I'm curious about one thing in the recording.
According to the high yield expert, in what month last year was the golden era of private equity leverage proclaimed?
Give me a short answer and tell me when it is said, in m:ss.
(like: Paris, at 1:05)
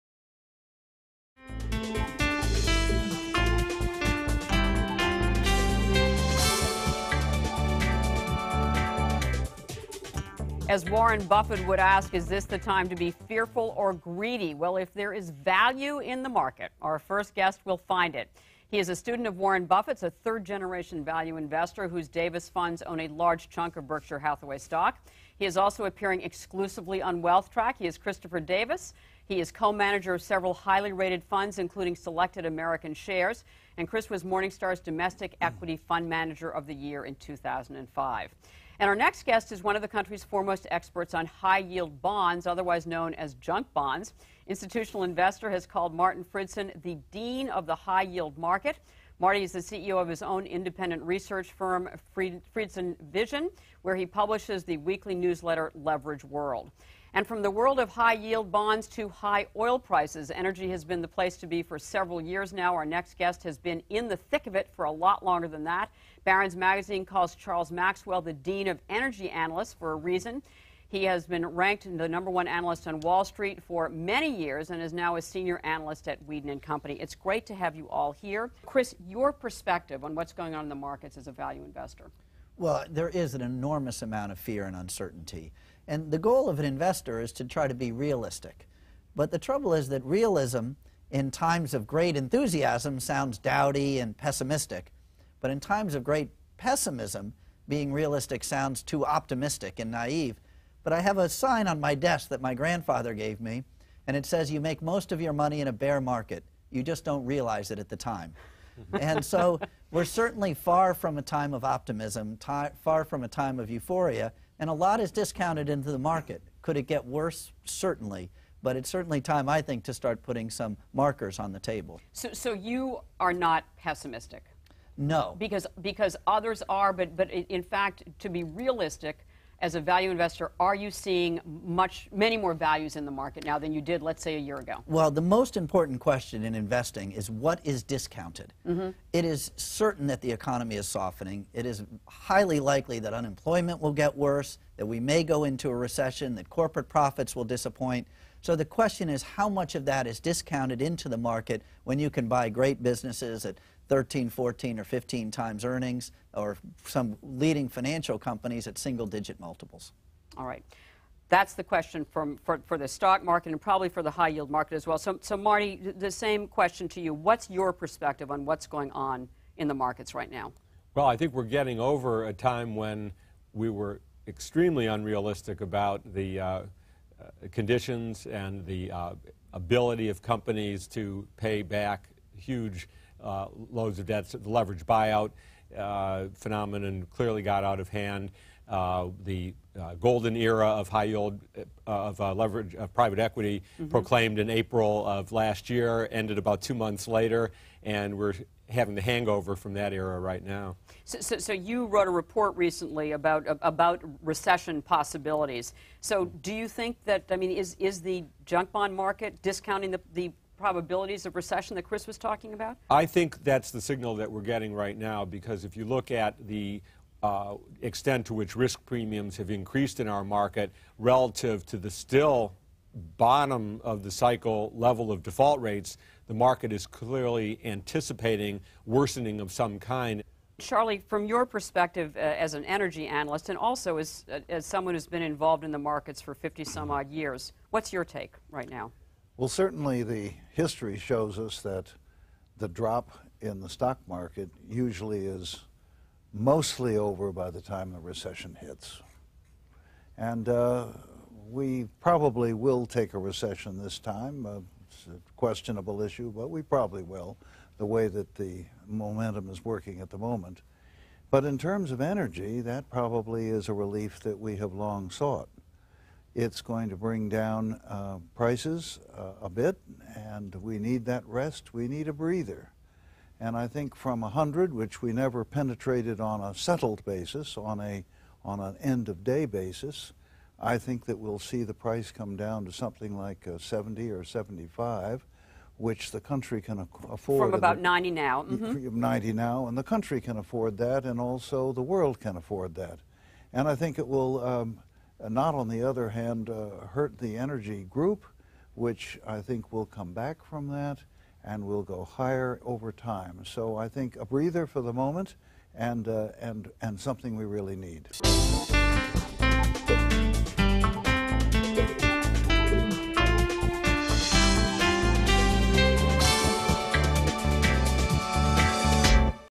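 April, at 3:14.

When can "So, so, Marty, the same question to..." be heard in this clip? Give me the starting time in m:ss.
2:44.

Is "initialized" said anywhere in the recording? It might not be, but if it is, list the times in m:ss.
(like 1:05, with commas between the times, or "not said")
not said.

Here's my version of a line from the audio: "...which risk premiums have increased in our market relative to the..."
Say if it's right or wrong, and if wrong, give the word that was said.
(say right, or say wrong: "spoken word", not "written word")
right.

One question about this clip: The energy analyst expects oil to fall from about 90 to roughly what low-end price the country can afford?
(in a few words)
70.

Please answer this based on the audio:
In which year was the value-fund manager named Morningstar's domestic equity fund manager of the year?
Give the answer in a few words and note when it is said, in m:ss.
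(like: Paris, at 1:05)
2005, at 0:37.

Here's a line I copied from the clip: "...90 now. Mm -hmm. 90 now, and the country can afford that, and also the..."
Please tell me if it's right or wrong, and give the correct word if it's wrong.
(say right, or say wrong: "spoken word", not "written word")
right.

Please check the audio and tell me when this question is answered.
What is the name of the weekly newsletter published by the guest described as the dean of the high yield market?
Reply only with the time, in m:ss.
0:55.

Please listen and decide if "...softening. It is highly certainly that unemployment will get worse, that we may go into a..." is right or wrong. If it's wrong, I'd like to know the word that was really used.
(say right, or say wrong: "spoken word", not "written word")
wrong: "likely", not "certainly".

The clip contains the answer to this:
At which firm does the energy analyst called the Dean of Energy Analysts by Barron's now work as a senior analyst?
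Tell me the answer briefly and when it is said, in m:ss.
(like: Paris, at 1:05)
Weeden and Company, at 1:16.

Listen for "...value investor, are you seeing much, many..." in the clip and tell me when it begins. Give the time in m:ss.
2:09.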